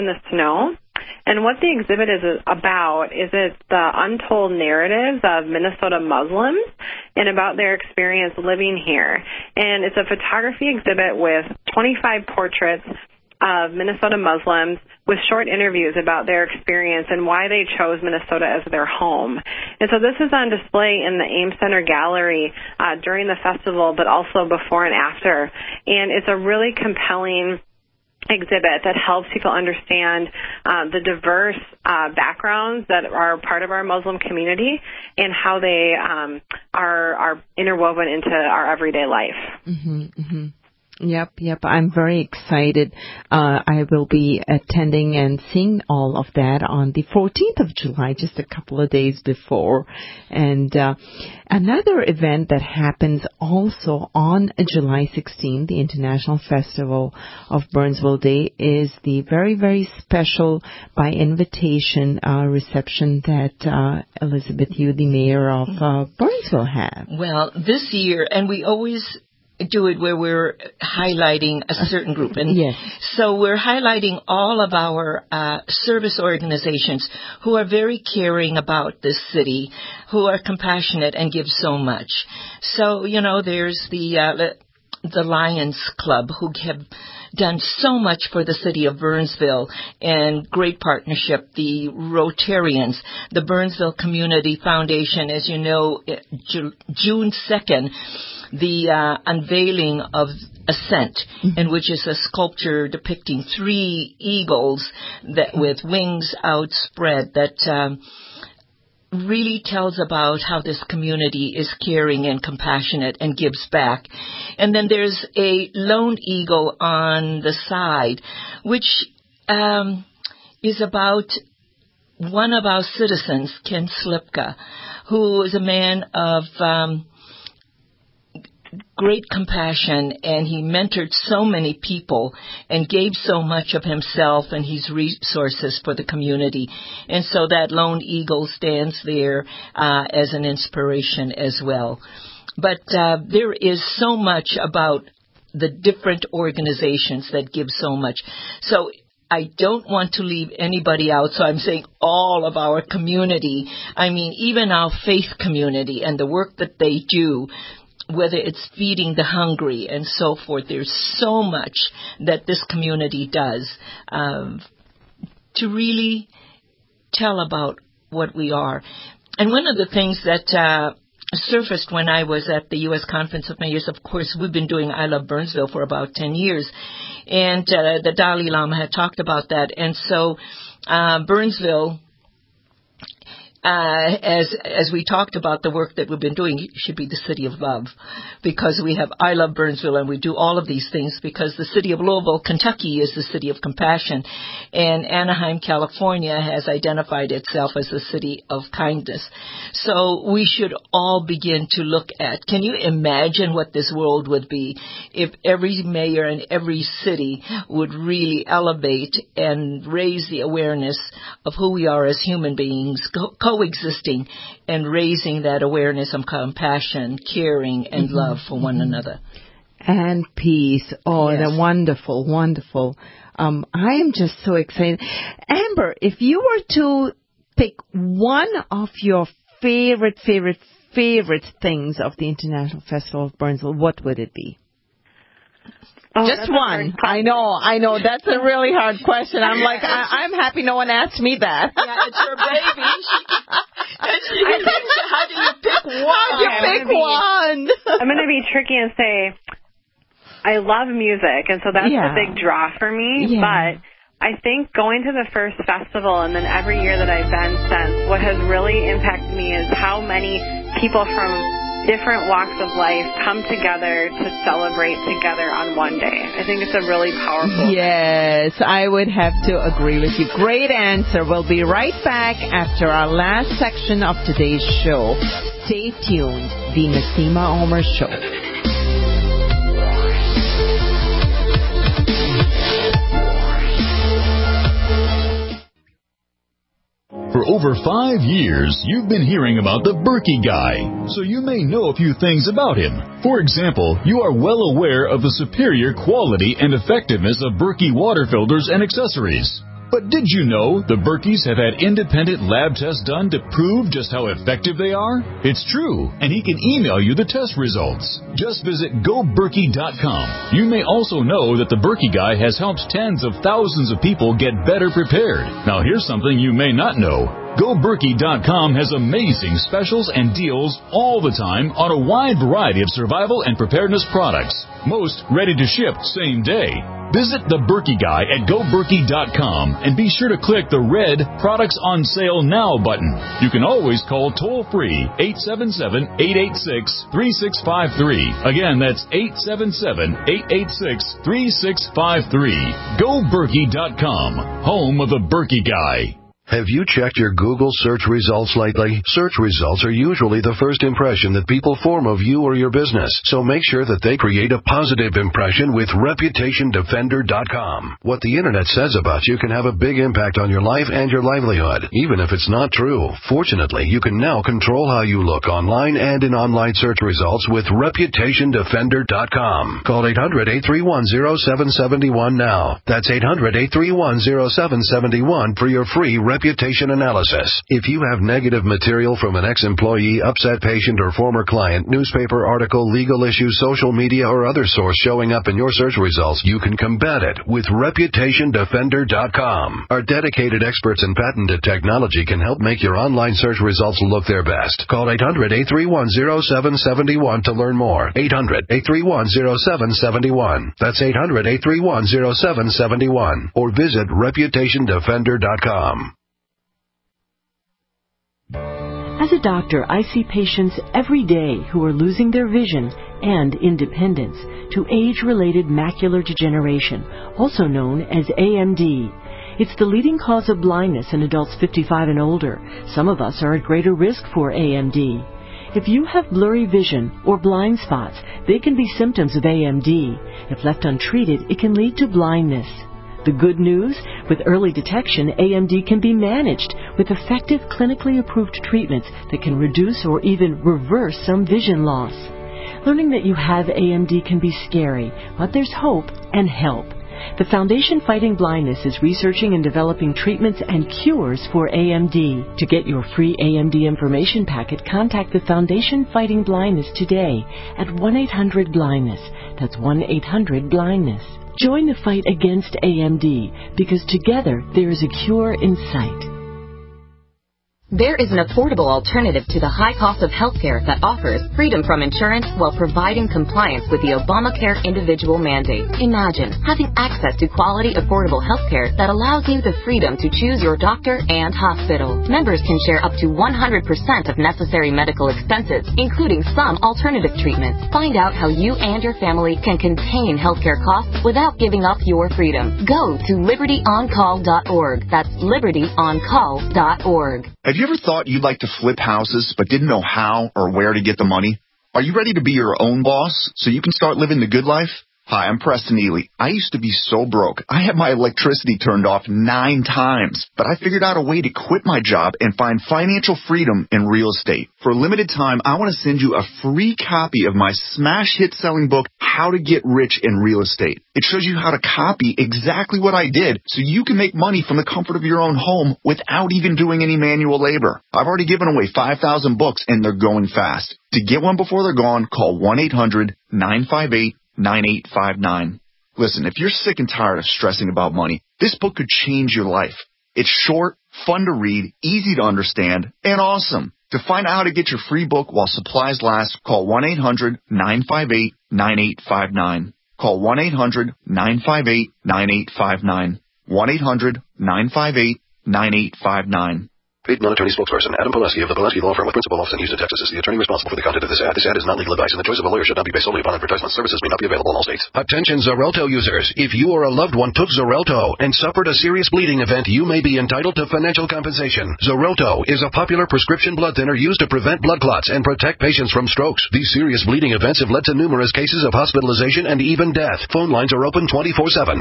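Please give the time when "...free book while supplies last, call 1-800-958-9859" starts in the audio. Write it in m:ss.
9:05.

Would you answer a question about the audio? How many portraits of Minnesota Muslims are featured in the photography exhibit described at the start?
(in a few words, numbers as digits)
25.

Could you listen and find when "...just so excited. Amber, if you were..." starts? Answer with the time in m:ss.
3:44.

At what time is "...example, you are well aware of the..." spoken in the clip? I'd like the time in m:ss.
4:53.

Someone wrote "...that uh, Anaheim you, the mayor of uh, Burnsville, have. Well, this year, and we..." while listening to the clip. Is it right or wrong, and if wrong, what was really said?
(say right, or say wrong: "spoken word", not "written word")
wrong: "Elizabeth", not "Anaheim".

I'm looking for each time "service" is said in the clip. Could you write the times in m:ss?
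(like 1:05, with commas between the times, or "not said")
1:15, 9:23.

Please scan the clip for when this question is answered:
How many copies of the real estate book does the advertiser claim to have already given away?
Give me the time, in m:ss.
8:48.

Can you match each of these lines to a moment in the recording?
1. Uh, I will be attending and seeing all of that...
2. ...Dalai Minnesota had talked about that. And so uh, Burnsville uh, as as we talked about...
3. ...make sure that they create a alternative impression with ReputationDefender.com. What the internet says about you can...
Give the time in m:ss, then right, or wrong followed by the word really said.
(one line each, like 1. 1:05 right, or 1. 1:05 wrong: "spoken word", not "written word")
1. 0:43 right
2. 2:58 wrong: "Lama", not "Minnesota"
3. 5:53 wrong: "positive", not "alternative".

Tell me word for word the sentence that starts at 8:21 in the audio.
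Are you ready to be your own boss so you can start living the good life?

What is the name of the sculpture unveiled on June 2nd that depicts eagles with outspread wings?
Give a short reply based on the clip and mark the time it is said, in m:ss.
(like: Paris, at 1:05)
Ascent, at 1:40.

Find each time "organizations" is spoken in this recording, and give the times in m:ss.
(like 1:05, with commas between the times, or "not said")
1:16, 2:26.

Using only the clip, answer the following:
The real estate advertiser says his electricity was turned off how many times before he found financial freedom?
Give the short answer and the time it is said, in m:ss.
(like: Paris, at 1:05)
9, at 8:29.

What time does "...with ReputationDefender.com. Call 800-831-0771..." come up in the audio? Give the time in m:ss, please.
6:07.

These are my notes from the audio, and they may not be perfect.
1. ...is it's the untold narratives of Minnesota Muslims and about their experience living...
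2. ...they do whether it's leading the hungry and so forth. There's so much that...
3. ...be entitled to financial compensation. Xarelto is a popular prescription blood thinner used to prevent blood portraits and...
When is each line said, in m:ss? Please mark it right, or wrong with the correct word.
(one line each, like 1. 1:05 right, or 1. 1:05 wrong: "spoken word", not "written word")
1. 0:03 right
2. 2:36 wrong: "feeding", not "leading"
3. 9:30 wrong: "clots", not "portraits".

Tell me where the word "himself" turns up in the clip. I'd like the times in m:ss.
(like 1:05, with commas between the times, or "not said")
2:13.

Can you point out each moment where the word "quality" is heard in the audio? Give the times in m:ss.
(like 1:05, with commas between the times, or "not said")
4:55, 7:57.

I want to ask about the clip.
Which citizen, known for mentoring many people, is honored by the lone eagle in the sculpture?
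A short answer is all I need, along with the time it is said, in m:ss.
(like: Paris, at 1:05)
Ken Slipka, at 2:03.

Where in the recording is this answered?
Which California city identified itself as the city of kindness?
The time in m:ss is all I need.
3:15.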